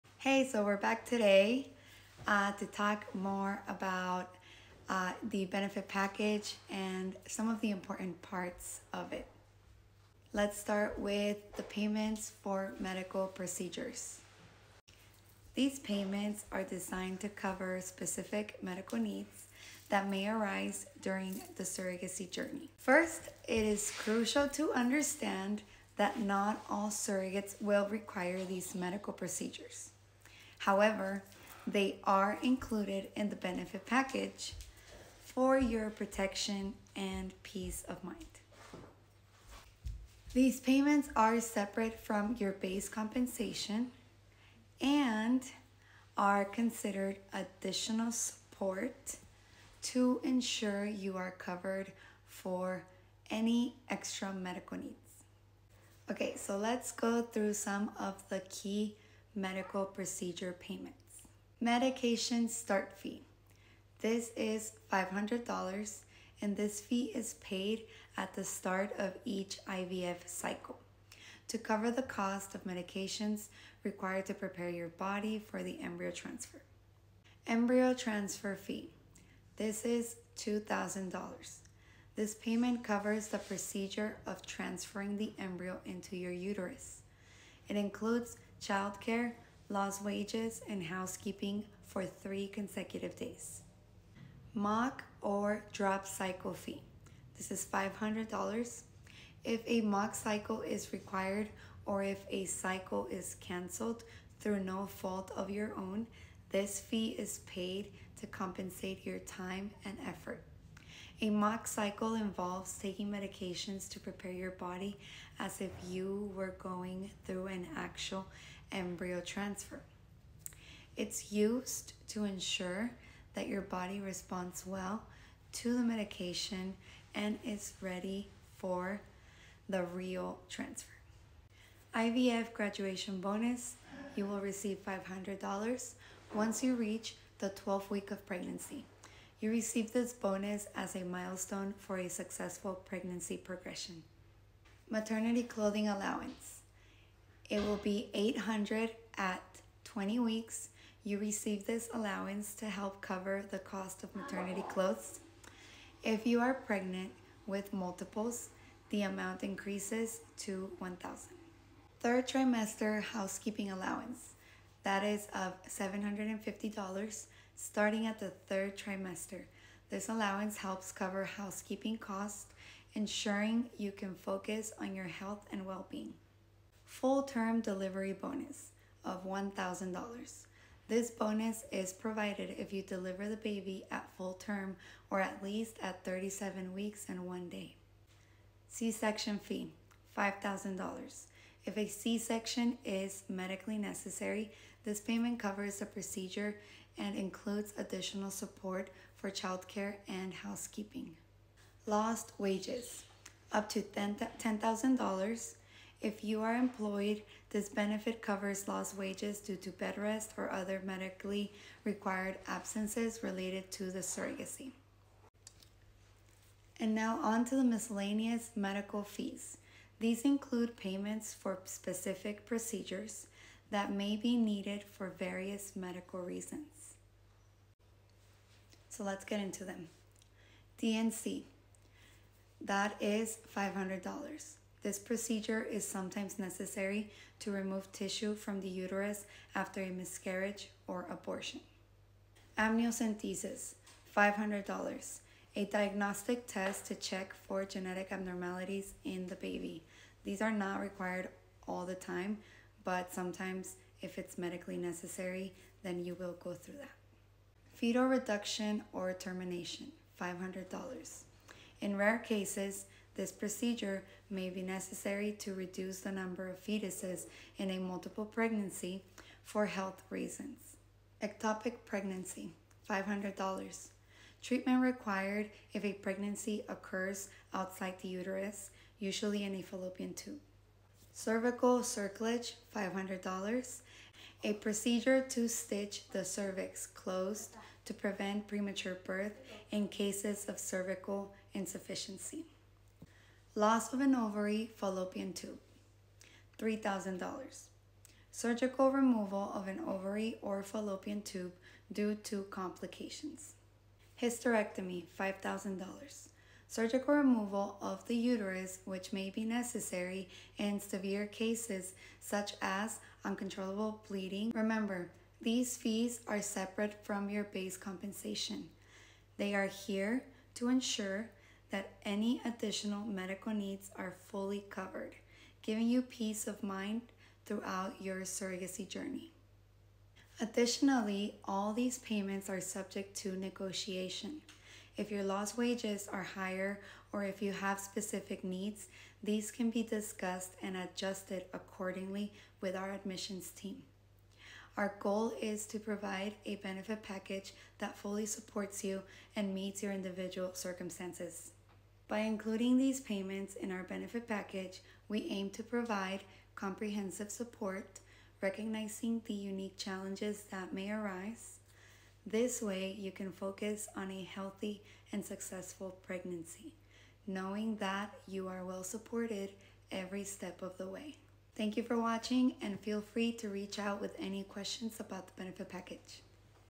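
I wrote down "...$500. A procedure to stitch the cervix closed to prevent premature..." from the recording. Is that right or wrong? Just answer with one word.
right.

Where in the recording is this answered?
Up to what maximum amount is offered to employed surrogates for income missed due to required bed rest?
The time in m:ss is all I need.
3:23.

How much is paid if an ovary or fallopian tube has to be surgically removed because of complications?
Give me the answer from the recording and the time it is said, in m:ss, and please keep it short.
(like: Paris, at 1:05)
$3,000, at 4:56.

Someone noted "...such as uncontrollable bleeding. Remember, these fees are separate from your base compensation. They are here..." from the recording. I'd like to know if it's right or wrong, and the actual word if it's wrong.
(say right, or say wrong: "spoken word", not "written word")
right.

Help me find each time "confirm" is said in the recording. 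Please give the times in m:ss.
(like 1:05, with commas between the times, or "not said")
not said.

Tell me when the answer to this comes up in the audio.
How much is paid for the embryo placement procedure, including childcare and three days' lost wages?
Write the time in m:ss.
1:19.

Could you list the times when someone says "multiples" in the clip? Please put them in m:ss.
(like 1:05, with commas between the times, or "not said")
2:37, 4:27.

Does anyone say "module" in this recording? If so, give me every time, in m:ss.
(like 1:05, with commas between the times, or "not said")
not said.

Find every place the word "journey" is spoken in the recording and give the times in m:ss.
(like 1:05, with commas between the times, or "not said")
0:22, 5:28.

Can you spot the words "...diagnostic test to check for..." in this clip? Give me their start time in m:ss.
4:05.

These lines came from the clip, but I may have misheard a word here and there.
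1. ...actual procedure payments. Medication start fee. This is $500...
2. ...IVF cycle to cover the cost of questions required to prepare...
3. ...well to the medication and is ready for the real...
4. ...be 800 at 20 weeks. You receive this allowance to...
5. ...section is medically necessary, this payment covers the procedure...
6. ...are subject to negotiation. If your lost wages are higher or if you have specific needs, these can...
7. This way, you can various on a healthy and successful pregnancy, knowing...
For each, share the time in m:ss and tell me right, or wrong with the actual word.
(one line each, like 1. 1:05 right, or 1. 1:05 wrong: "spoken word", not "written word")
1. 0:59 wrong: "medical", not "actual"
2. 1:09 wrong: "medications", not "questions"
3. 2:04 right
4. 2:27 right
5. 3:12 right
6. 5:32 right
7. 6:02 wrong: "focus", not "various".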